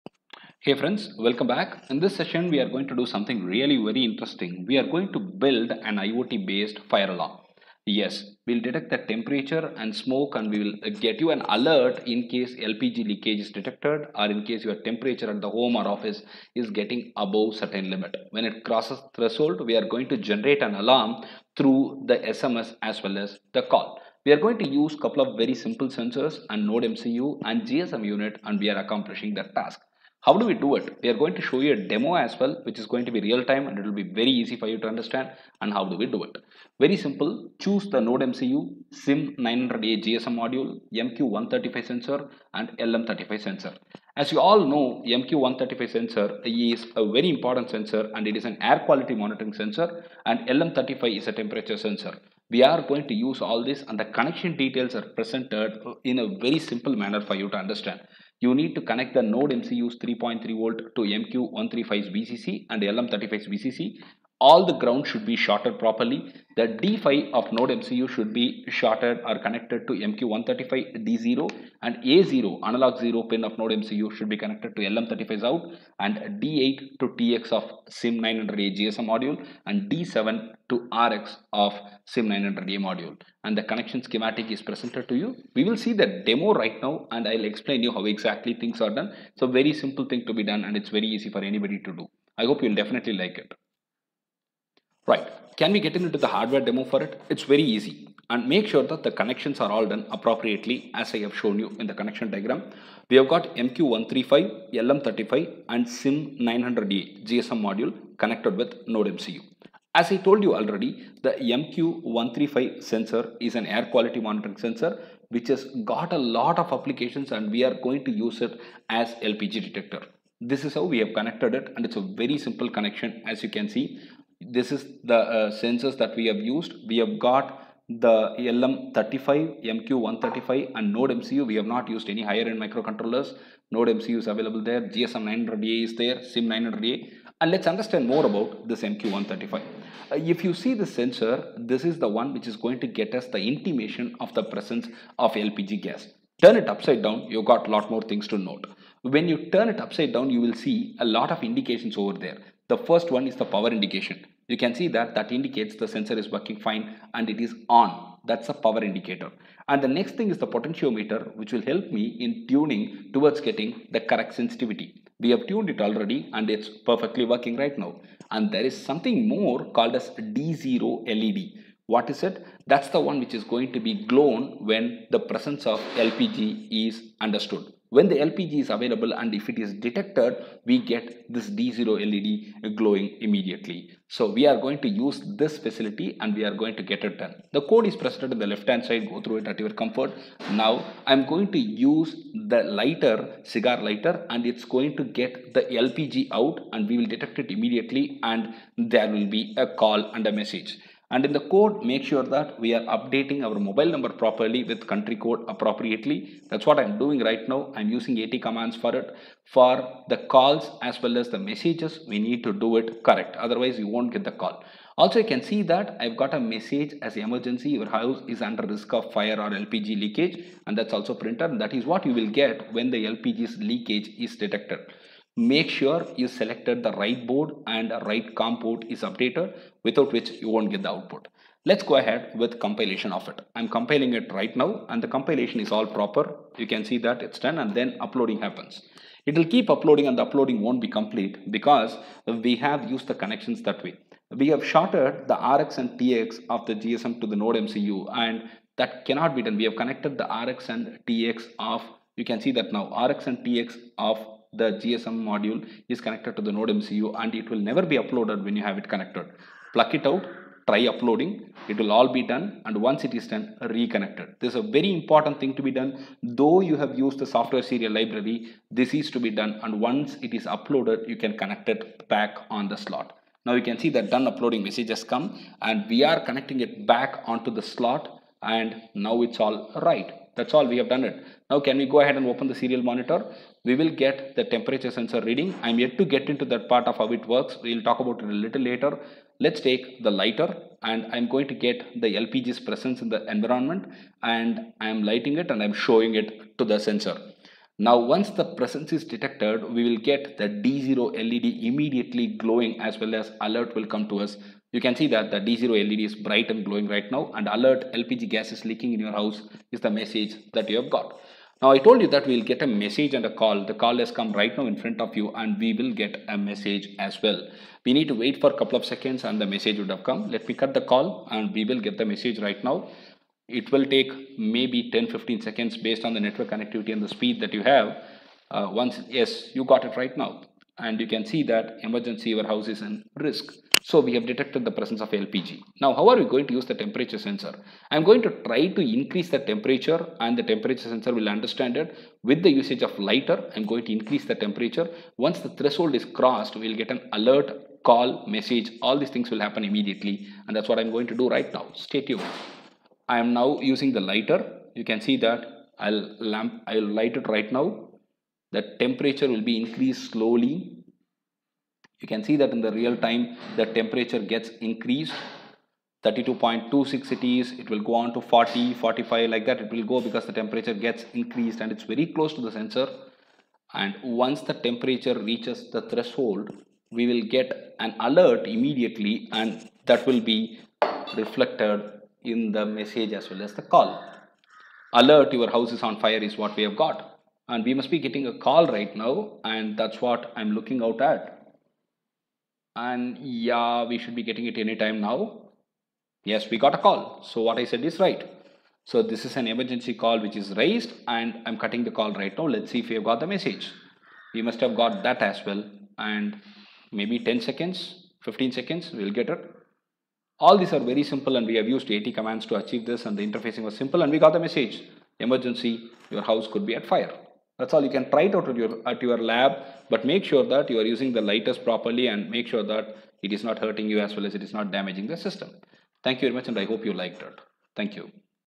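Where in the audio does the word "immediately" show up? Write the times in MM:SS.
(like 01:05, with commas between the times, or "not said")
03:03, 03:17, 05:01, 05:49, 06:18.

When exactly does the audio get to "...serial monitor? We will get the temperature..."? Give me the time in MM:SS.
04:42.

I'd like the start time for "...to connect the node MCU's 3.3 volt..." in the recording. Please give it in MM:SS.
00:58.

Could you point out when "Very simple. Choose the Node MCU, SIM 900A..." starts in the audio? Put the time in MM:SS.
00:36.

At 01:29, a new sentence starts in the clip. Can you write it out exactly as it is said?
So very simple thing to be done and it's very easy for anybody to do.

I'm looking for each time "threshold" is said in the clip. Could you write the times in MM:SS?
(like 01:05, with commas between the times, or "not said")
00:19, 05:45, 06:15.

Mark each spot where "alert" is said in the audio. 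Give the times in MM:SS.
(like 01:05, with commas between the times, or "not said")
00:11, 05:03, 05:07, 05:47, 06:18, 06:25.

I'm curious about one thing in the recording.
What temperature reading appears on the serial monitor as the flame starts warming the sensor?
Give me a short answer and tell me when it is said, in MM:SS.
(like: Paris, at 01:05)
32.26, at 06:06.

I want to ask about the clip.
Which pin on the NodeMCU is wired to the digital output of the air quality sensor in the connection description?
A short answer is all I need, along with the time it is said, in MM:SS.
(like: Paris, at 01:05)
D5, at 01:06.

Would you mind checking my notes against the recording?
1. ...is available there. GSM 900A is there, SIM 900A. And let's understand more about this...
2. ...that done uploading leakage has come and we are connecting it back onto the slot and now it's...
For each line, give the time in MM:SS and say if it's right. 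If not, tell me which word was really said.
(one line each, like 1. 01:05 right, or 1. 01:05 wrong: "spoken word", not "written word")
1. 02:14 right
2. 04:33 wrong: "message", not "leakage".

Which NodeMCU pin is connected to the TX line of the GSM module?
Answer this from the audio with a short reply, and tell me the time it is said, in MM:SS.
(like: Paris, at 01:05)
D8, at 01:16.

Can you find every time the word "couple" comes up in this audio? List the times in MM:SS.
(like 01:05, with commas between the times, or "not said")
00:24, 05:18.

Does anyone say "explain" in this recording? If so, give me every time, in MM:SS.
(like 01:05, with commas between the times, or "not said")
01:27.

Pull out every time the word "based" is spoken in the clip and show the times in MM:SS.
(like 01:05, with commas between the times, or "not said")
00:06, 05:25.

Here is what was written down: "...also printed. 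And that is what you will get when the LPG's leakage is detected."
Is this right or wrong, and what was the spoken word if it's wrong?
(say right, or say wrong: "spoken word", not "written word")
right.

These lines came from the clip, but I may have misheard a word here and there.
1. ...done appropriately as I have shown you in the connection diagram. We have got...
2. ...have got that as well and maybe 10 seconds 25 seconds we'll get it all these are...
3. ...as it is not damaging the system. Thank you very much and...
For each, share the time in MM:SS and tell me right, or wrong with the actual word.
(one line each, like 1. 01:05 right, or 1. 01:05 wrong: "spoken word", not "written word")
1. 01:39 right
2. 06:44 wrong: "15", not "25"
3. 07:04 right.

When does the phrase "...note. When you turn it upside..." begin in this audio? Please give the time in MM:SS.
02:28.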